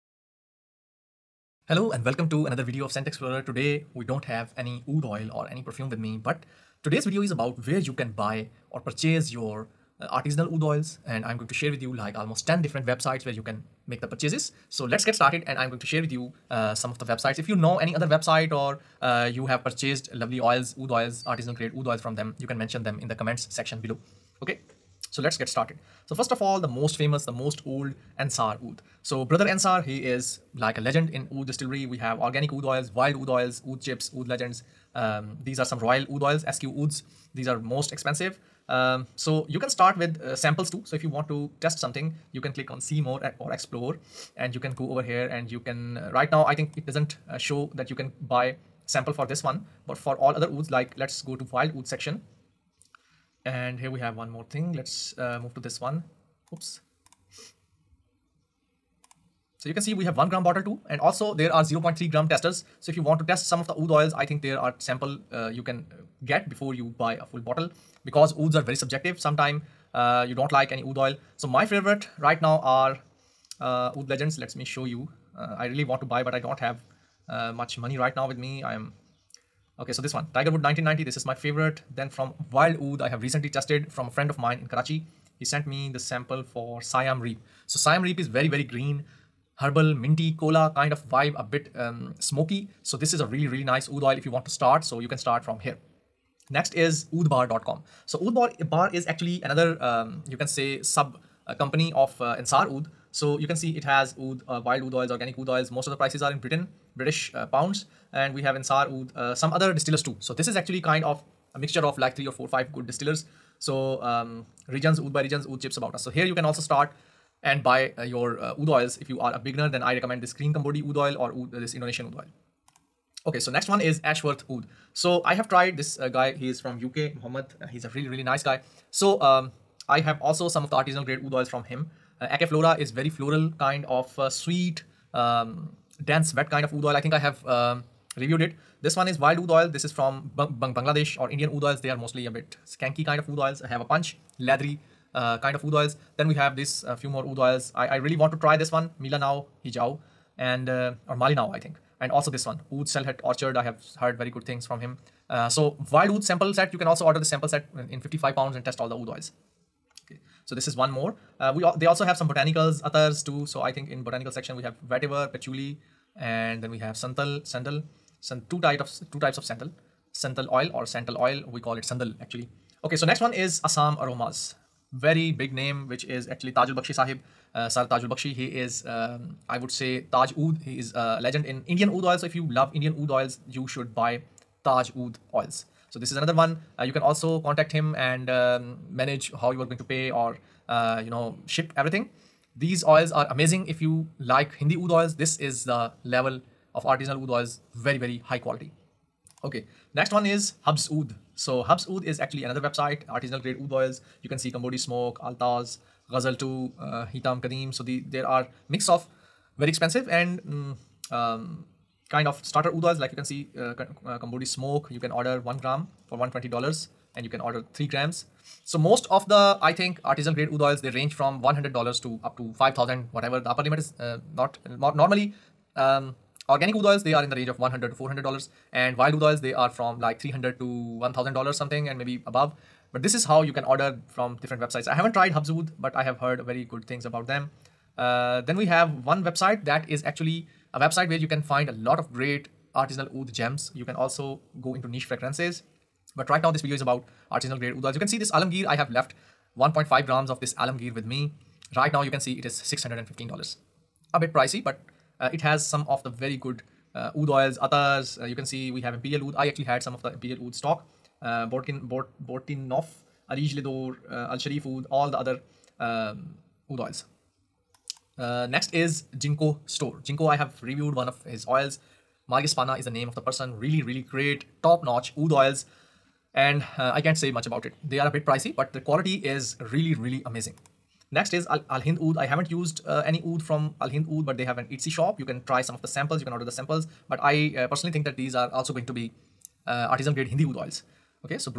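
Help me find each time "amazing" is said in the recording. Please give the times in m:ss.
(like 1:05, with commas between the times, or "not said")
3:13, 4:40.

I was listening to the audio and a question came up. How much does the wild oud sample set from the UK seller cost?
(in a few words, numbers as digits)
55 pounds.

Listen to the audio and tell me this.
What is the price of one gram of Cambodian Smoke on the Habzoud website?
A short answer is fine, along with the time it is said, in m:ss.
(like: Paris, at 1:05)
120 dollars, at 3:36.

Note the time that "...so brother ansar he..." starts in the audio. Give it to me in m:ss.
0:29.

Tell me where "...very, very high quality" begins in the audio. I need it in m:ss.
3:17.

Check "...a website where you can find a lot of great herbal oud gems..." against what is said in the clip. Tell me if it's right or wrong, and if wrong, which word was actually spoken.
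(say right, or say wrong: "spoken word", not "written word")
wrong: "artisanal", not "herbal".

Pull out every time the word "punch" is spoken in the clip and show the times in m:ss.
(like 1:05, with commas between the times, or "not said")
2:23.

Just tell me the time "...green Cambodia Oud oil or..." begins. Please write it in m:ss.
2:00.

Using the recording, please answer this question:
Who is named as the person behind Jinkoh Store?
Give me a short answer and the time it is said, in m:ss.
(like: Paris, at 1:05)
Marius Pana, at 4:32.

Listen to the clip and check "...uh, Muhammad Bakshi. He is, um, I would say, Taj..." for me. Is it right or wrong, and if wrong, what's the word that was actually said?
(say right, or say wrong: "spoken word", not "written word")
wrong: "Tajul", not "Muhammad".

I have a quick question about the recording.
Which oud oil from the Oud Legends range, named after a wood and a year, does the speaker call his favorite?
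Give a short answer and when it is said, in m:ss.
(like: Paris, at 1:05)
Tiger Wood 1990, at 1:20.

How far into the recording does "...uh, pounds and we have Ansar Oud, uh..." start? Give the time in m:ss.
1:47.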